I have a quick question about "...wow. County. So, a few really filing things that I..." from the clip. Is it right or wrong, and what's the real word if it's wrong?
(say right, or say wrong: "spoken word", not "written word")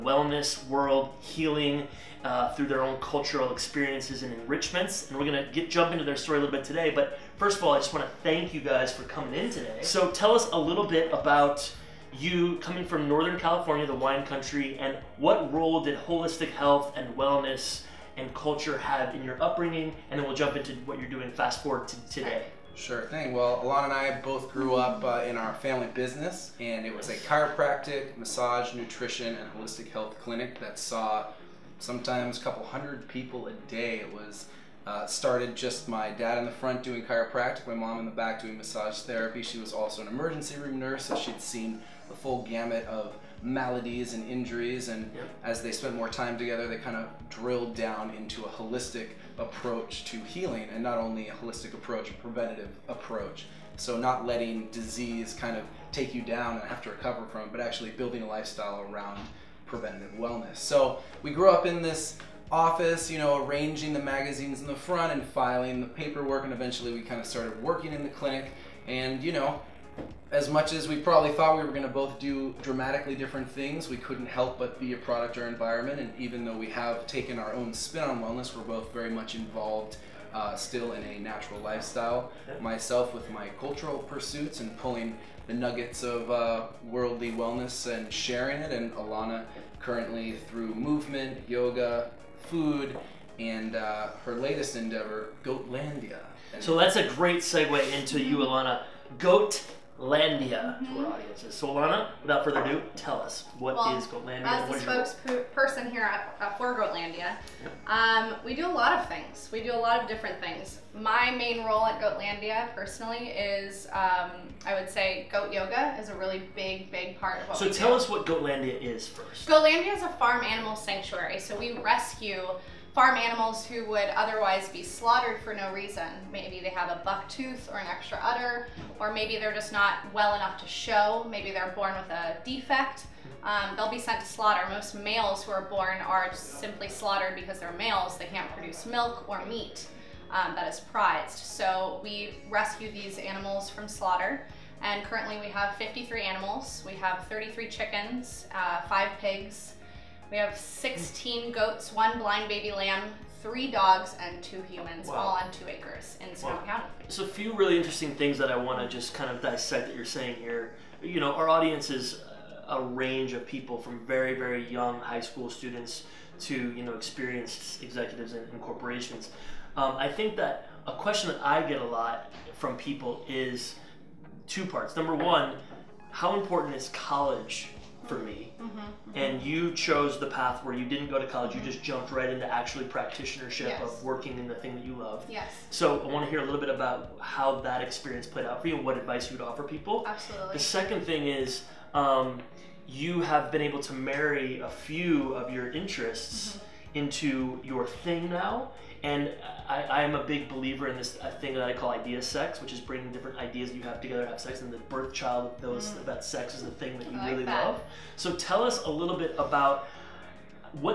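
wrong: "interesting", not "filing".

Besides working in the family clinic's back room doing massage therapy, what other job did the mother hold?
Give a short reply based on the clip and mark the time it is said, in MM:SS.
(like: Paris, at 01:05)
Emergency room nurse, at 00:40.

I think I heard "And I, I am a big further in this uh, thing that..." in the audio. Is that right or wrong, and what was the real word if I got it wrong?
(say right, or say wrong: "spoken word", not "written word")
wrong: "believer", not "further".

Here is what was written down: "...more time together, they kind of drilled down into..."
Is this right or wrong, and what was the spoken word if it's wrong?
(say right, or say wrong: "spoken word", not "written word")
right.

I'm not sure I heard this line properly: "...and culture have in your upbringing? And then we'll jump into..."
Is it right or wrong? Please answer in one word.
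right.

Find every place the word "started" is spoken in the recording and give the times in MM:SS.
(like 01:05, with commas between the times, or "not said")
00:35, 01:07.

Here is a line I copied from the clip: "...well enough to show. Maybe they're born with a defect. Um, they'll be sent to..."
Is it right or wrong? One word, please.
right.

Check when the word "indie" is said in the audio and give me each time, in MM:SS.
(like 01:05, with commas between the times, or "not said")
not said.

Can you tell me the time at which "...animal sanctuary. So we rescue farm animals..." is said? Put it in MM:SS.
02:00.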